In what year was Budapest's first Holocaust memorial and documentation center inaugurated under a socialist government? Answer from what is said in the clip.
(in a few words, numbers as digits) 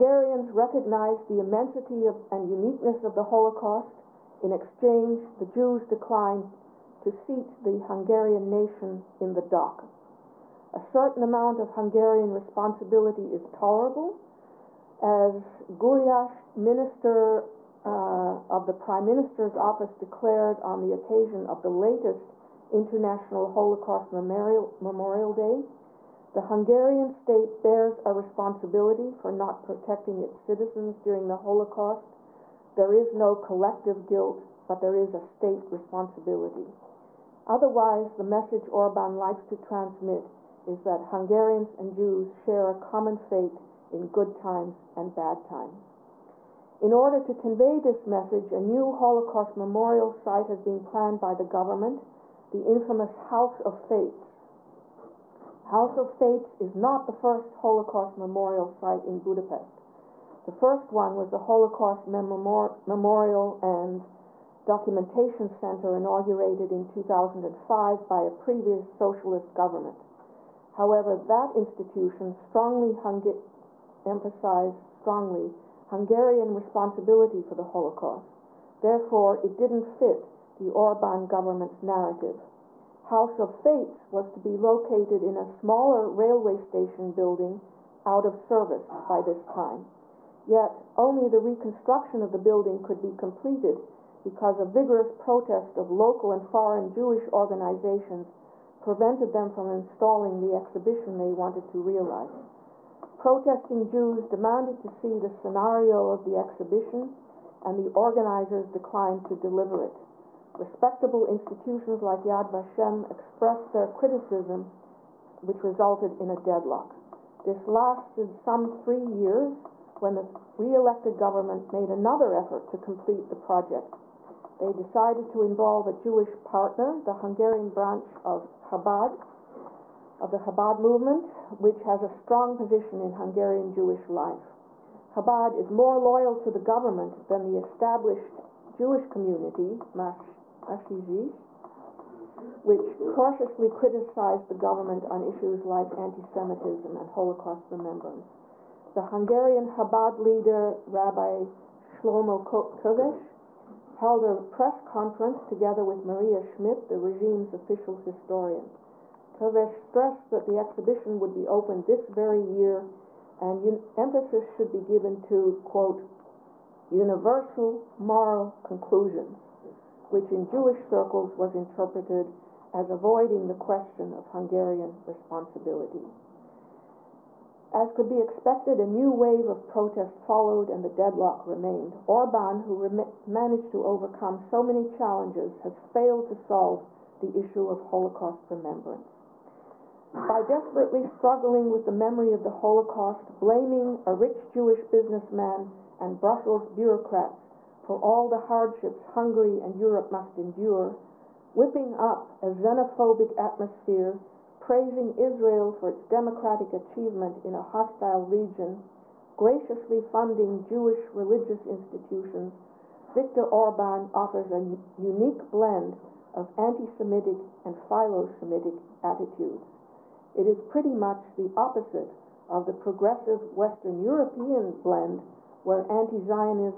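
2005.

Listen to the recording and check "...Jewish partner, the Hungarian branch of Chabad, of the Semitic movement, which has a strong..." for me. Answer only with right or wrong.
wrong.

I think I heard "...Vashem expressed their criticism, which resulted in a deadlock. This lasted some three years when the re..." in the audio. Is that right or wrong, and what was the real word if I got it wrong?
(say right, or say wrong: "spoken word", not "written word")
right.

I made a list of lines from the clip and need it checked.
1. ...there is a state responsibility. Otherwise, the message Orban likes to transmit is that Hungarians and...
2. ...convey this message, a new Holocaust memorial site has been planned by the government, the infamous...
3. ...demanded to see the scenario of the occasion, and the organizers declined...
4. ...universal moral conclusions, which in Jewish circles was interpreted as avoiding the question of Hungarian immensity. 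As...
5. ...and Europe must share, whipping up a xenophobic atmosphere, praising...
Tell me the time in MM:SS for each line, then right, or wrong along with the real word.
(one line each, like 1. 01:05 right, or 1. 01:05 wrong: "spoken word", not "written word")
1. 00:34 right
2. 00:47 right
3. 01:44 wrong: "exhibition", not "occasion"
4. 02:46 wrong: "responsibility", not "immensity"
5. 03:19 wrong: "endure", not "share".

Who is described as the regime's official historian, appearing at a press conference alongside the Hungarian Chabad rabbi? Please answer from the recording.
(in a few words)
Maria Schmidt.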